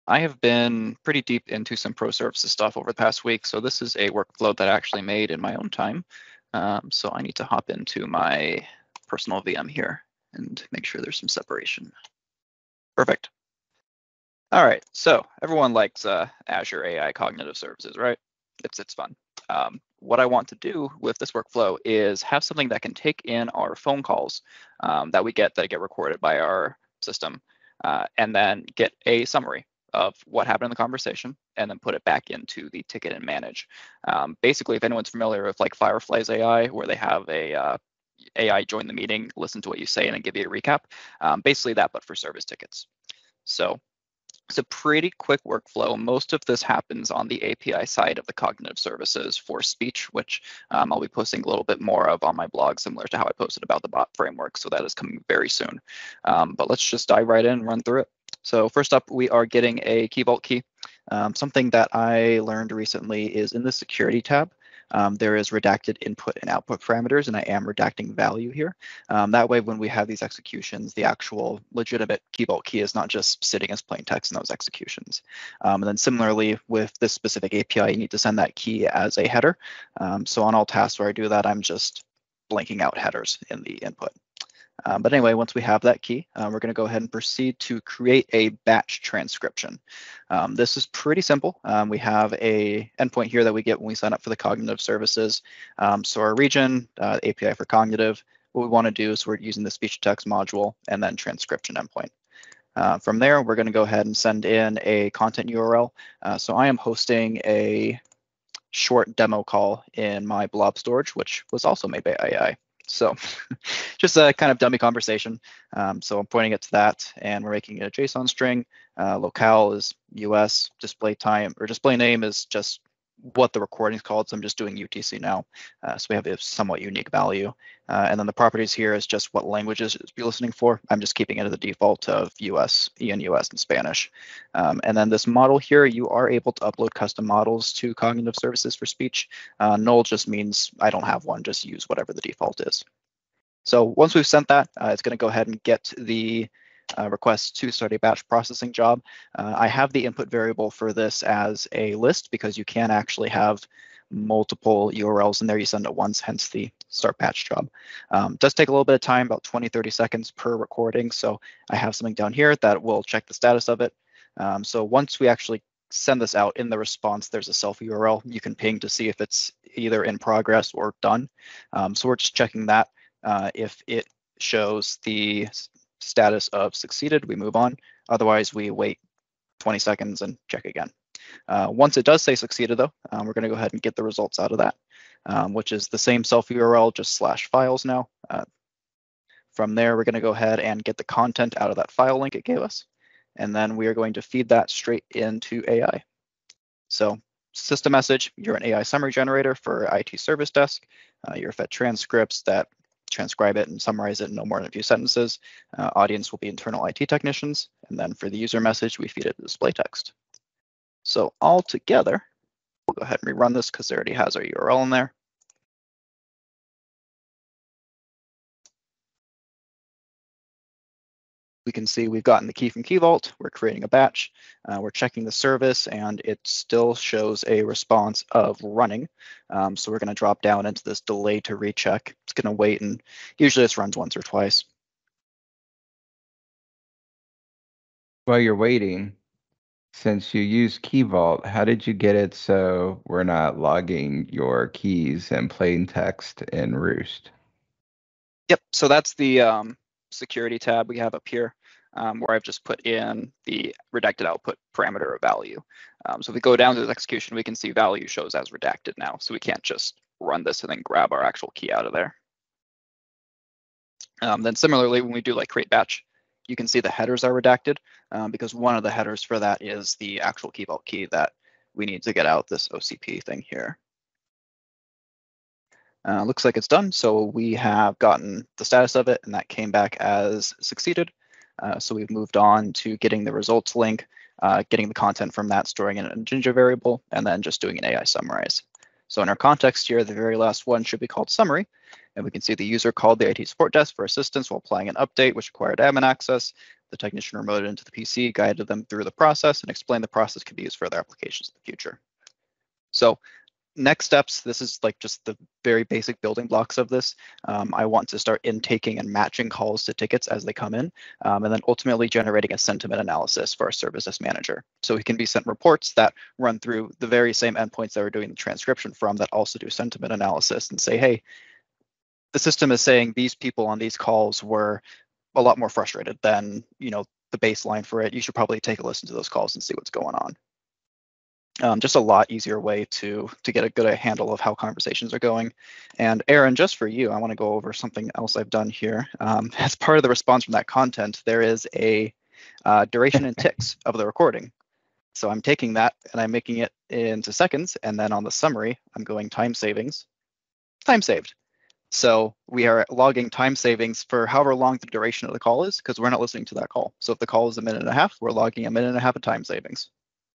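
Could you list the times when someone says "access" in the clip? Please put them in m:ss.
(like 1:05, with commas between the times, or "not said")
4:56.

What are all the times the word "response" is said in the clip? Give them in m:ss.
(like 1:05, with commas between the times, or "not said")
2:46, 3:47, 5:40.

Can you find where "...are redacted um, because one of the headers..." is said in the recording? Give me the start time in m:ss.
4:27.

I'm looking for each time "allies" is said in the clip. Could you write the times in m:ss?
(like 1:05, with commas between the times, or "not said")
not said.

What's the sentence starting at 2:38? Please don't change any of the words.
Um, does take a little bit of time, about 20, 30 seconds per recording.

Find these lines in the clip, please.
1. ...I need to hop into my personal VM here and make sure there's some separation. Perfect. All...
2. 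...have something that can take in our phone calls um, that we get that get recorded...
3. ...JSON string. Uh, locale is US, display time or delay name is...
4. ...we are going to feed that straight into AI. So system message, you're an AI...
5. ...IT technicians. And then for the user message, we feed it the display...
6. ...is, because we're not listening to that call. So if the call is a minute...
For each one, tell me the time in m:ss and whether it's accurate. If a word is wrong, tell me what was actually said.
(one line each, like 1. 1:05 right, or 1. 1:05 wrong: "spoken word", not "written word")
1. 0:07 right
2. 0:22 right
3. 1:58 wrong: "display", not "delay"
4. 3:13 right
5. 3:26 right
6. 5:55 right.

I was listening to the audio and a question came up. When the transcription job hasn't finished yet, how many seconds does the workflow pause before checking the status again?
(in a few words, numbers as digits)
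20 seconds.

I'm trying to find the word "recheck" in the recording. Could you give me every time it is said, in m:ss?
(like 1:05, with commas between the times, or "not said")
3:51.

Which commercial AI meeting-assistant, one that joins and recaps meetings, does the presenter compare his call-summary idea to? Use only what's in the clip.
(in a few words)
Fireflies AI.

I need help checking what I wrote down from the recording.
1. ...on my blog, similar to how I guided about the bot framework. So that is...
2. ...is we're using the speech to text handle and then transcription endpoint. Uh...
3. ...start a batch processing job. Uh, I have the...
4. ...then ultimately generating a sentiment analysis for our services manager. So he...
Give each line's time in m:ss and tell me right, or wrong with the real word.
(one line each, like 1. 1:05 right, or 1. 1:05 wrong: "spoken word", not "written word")
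1. 0:52 wrong: "posted", not "guided"
2. 1:39 wrong: "module", not "handle"
3. 2:27 right
4. 5:11 right.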